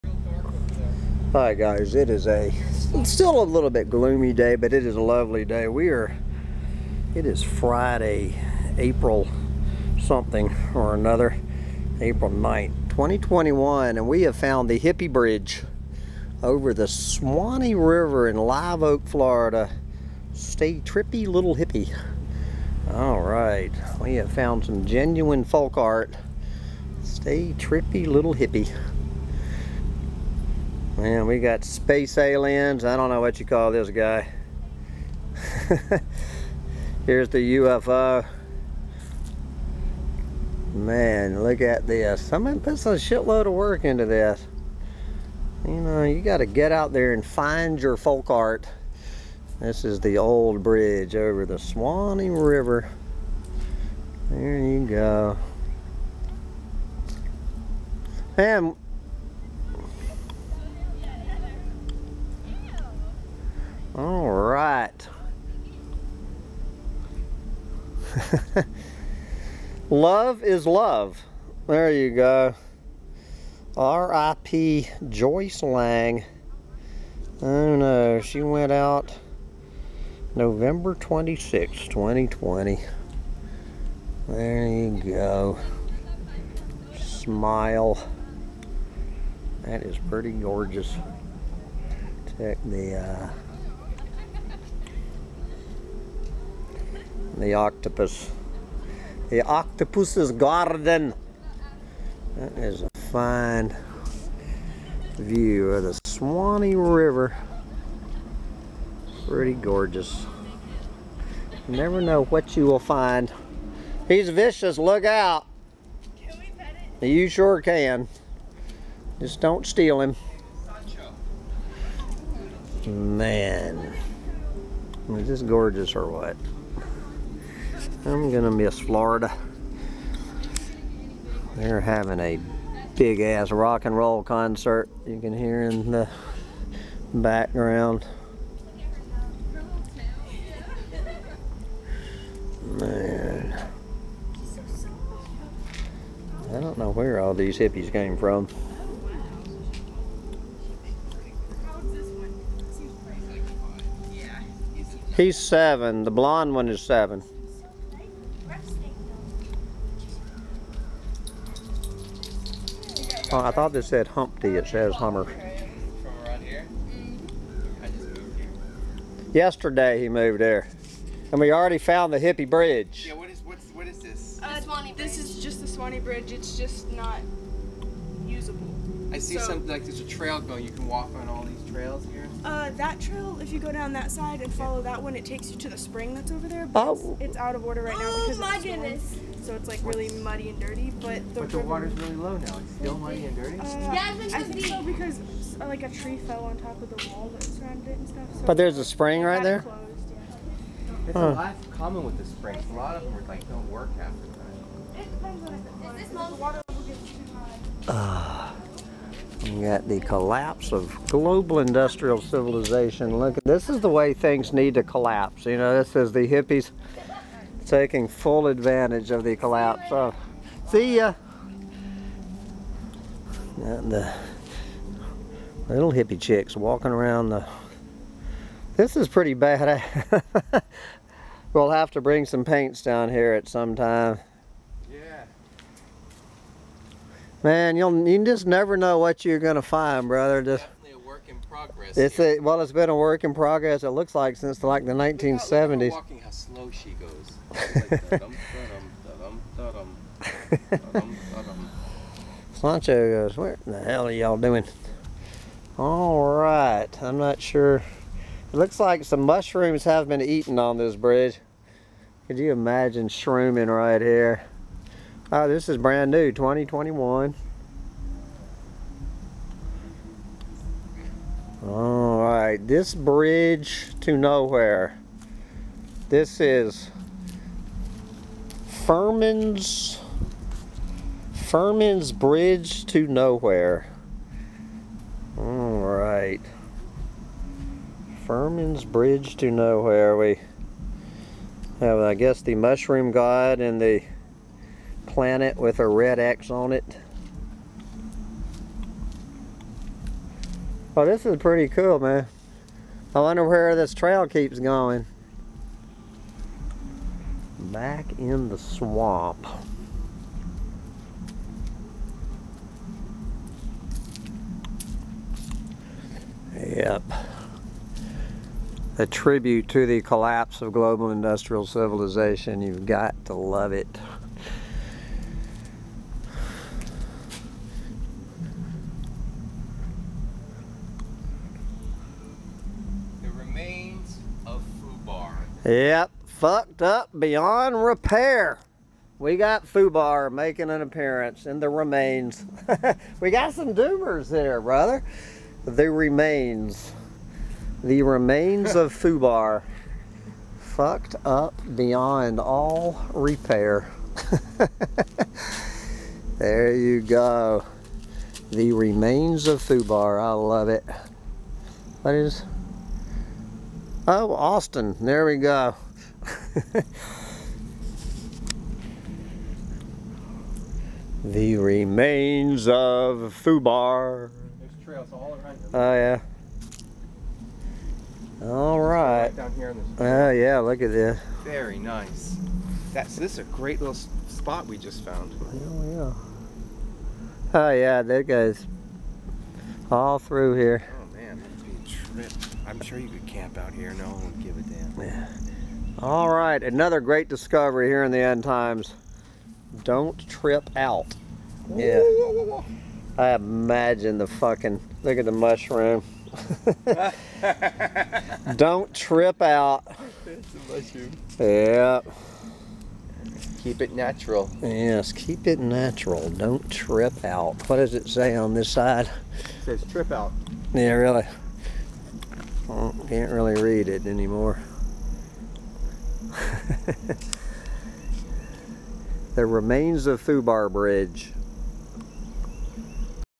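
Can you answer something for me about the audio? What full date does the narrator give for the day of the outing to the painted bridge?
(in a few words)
April 9, 2021.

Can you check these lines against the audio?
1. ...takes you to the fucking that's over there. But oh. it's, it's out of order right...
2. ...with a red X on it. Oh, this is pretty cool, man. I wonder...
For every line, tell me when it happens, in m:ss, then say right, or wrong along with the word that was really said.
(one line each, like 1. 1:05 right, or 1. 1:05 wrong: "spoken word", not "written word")
1. 3:05 wrong: "spring", not "fucking"
2. 4:55 right.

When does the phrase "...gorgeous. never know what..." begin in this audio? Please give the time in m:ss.
1:49.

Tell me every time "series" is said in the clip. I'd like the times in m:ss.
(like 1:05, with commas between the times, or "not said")
not said.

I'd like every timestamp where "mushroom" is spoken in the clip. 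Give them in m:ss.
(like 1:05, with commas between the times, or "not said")
4:19, 4:52, 6:45, 6:50.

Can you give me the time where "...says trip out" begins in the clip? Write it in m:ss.
6:59.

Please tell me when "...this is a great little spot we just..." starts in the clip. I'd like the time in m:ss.
6:23.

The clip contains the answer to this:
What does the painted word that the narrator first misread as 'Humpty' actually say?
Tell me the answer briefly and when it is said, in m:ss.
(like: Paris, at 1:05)
Hummer, at 2:44.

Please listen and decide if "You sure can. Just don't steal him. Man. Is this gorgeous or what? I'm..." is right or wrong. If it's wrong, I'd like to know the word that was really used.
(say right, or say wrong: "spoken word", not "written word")
right.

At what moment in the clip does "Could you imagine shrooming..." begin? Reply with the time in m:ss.
4:22.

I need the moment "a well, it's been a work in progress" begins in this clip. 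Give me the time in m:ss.
4:02.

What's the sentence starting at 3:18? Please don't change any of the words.
So but there's a spring right there.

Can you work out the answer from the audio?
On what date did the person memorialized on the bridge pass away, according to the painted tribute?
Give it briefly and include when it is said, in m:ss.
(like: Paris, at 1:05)
November 26, 2020, at 1:20.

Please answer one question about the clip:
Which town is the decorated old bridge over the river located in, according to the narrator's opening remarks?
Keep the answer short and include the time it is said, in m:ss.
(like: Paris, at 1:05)
Live Oak, Florida, at 0:18.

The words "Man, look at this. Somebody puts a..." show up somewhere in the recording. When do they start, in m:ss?
0:40.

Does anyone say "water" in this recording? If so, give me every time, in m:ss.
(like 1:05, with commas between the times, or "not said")
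3:11, 3:26.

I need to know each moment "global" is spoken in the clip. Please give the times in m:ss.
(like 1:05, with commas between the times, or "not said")
3:31, 5:20.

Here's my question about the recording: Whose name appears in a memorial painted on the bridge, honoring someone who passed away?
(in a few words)
Joyce Lang.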